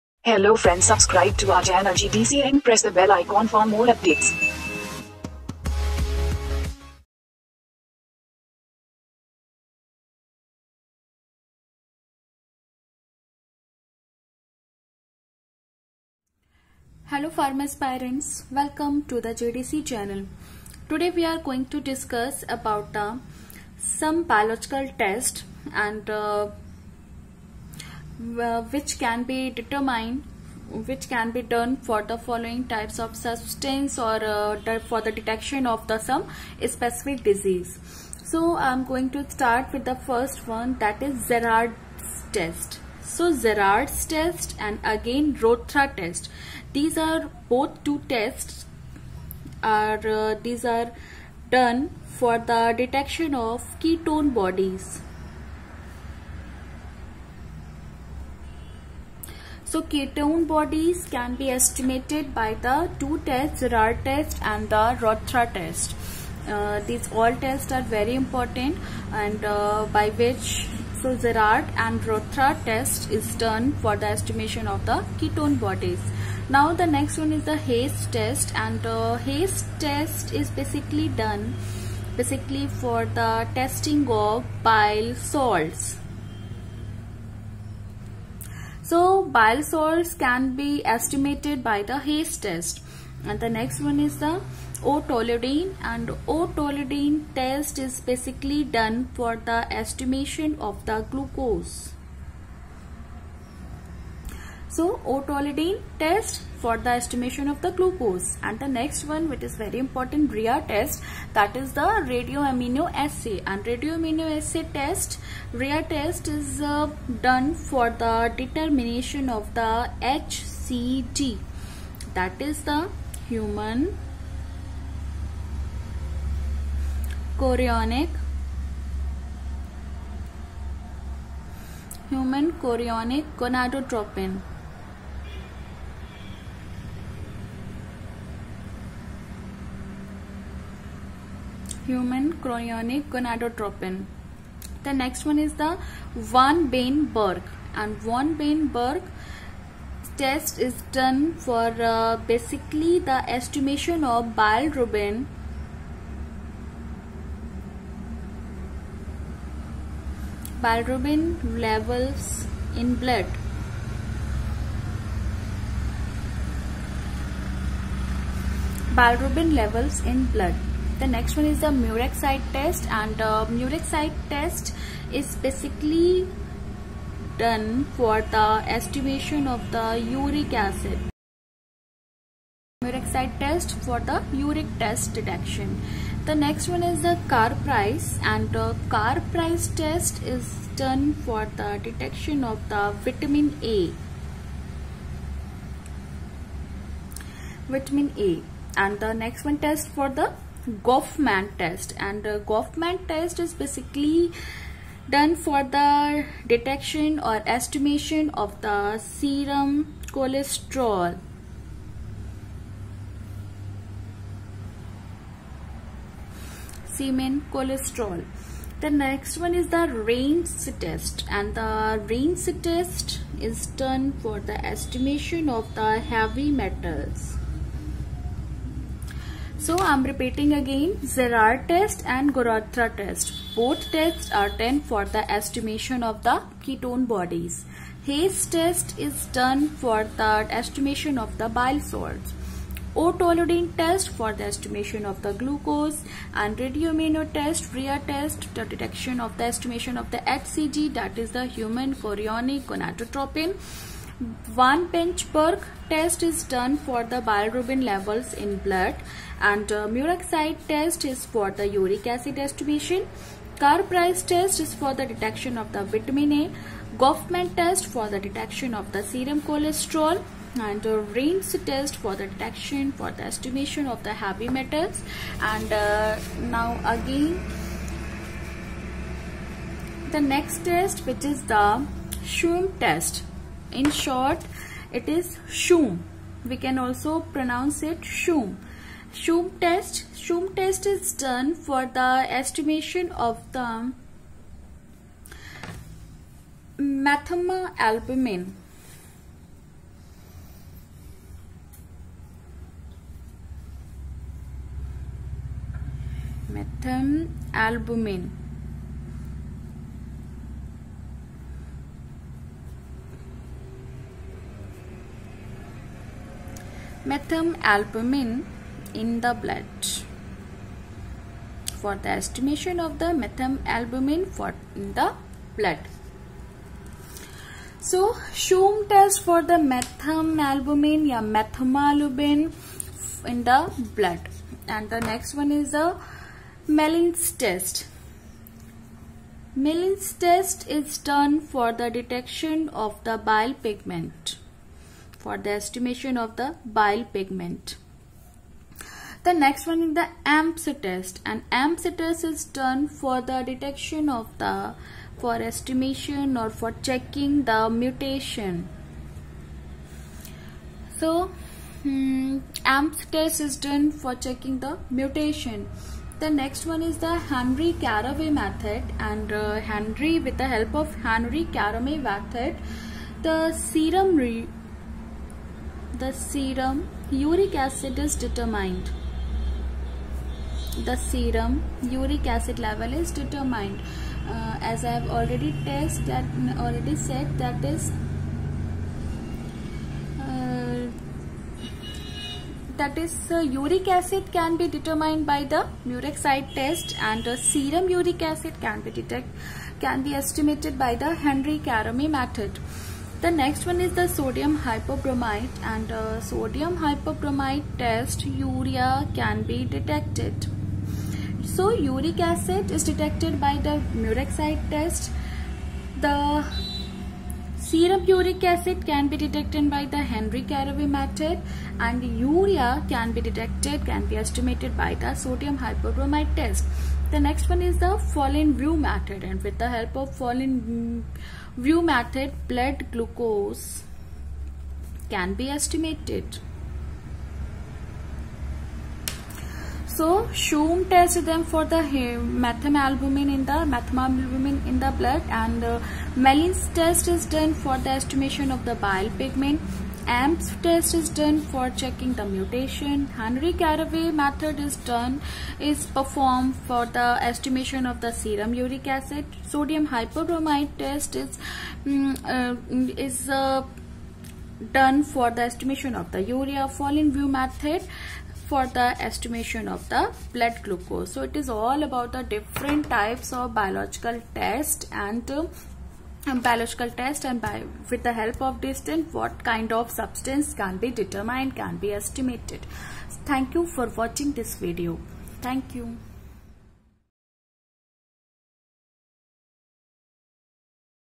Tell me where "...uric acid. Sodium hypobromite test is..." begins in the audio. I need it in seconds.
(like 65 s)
458 s.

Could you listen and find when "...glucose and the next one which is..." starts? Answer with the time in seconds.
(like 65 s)
107 s.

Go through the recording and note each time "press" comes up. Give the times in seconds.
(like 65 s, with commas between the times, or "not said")
2 s.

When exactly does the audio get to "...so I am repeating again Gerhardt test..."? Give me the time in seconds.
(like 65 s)
229 s.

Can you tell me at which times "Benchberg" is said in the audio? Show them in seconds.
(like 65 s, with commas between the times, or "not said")
254 s.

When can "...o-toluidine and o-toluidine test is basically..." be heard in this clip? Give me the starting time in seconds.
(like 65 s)
94 s.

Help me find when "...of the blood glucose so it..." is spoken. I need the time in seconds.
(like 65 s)
469 s.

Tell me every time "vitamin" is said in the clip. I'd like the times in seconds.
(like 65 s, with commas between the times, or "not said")
193 s, 197 s, 265 s.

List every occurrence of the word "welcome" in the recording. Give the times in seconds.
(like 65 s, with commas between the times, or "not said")
18 s.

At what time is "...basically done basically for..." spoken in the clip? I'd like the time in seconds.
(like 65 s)
80 s.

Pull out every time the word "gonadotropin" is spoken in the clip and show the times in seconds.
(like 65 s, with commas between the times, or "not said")
133 s, 143 s, 252 s.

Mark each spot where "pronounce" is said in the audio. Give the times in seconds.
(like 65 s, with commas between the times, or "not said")
287 s.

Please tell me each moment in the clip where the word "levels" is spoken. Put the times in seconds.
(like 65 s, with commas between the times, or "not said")
161 s, 169 s, 257 s, 382 s.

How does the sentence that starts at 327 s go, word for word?
So, Schumm test for the methamphetamine or methemalbumin in the blood.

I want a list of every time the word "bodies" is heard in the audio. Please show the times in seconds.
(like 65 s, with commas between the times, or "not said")
54 s, 60 s, 75 s, 237 s.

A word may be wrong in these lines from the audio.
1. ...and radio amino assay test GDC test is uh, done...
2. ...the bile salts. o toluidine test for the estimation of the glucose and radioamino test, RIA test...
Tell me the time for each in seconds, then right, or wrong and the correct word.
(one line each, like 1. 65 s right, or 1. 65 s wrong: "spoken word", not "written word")
1. 113 s wrong: "RIA", not "GDC"
2. 241 s right.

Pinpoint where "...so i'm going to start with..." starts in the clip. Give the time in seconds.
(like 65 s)
38 s.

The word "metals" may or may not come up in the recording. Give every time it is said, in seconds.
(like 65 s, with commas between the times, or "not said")
226 s, 274 s.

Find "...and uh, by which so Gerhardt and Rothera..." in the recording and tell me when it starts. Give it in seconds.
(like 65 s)
69 s.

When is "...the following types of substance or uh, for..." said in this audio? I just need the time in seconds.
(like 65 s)
32 s.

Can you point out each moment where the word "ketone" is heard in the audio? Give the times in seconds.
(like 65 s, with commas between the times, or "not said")
53 s, 59 s, 75 s, 236 s.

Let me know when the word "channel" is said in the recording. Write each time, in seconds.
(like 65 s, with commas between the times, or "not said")
1 s, 19 s.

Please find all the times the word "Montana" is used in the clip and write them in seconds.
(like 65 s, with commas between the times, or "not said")
not said.